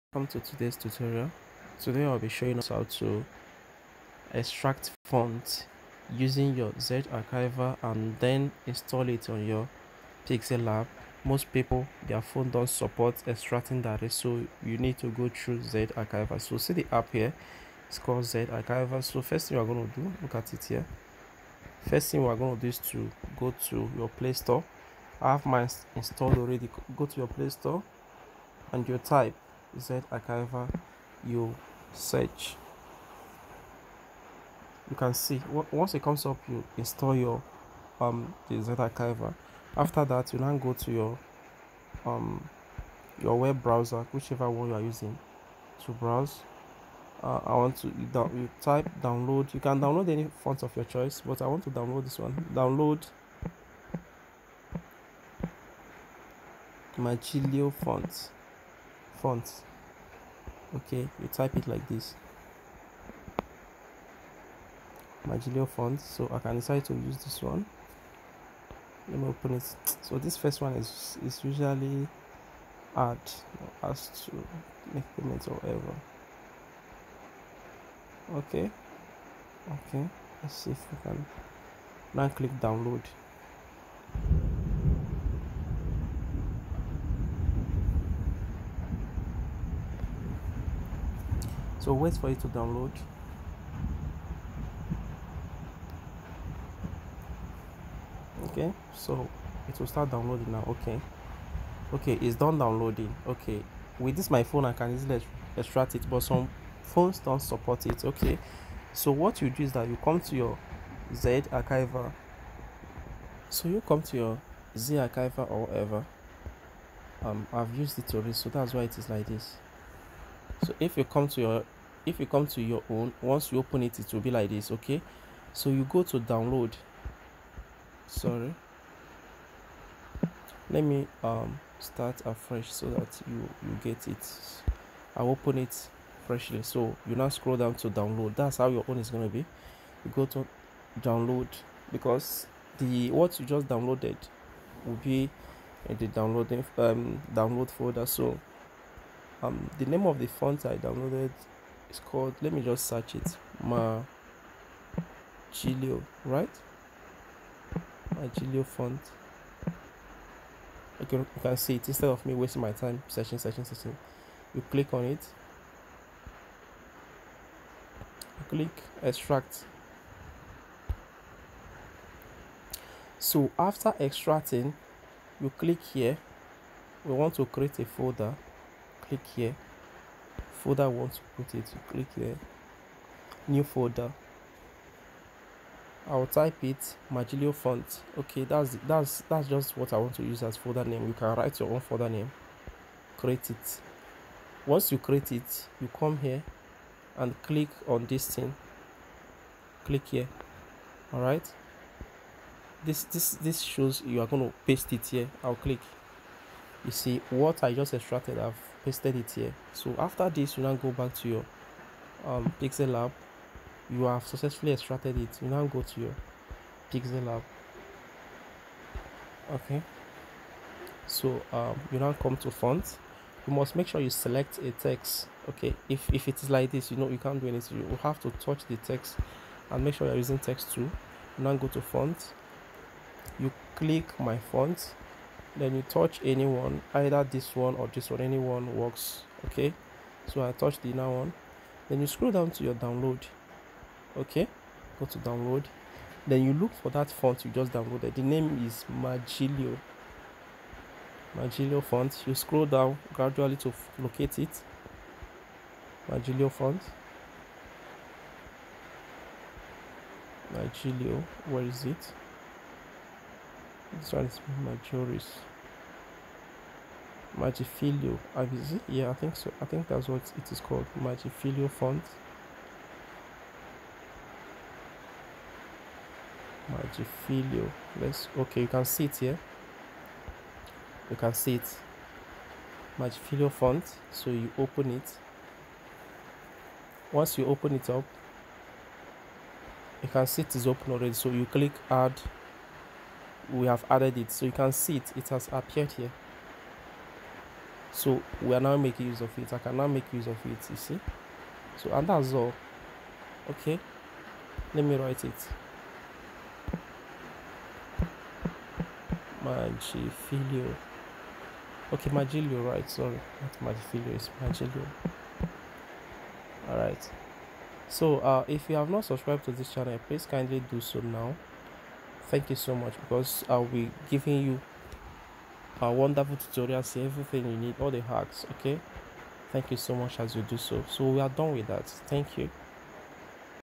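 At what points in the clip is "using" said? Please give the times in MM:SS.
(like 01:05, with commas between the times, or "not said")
00:06, 00:44, 03:50.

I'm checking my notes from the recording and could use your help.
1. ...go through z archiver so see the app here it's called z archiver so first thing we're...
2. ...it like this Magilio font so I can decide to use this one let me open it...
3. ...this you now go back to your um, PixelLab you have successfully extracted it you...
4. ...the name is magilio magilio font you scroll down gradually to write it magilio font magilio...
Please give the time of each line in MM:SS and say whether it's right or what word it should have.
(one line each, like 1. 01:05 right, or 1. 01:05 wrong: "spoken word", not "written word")
1. 00:15 right
2. 01:01 right
3. 03:30 right
4. 04:08 wrong: "locate", not "write".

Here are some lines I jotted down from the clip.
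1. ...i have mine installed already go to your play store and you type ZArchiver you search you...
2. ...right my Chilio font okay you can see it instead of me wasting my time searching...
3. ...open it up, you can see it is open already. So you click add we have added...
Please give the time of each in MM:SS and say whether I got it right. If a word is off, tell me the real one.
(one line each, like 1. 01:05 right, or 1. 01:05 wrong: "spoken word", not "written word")
1. 00:25 right
2. 02:36 right
3. 04:47 right.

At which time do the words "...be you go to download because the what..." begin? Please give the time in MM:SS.
02:19.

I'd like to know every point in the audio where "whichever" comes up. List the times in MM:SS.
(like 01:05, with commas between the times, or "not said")
00:44.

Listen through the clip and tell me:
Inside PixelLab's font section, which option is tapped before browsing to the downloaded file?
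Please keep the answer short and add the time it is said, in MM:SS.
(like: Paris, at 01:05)
my font, at 03:54.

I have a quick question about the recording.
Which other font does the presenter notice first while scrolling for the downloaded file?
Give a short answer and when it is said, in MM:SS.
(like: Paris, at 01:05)
Majoris, at 04:24.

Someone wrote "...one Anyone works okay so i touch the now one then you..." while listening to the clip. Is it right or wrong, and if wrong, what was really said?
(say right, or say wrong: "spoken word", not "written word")
right.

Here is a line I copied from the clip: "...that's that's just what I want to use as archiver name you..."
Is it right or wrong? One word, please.
wrong.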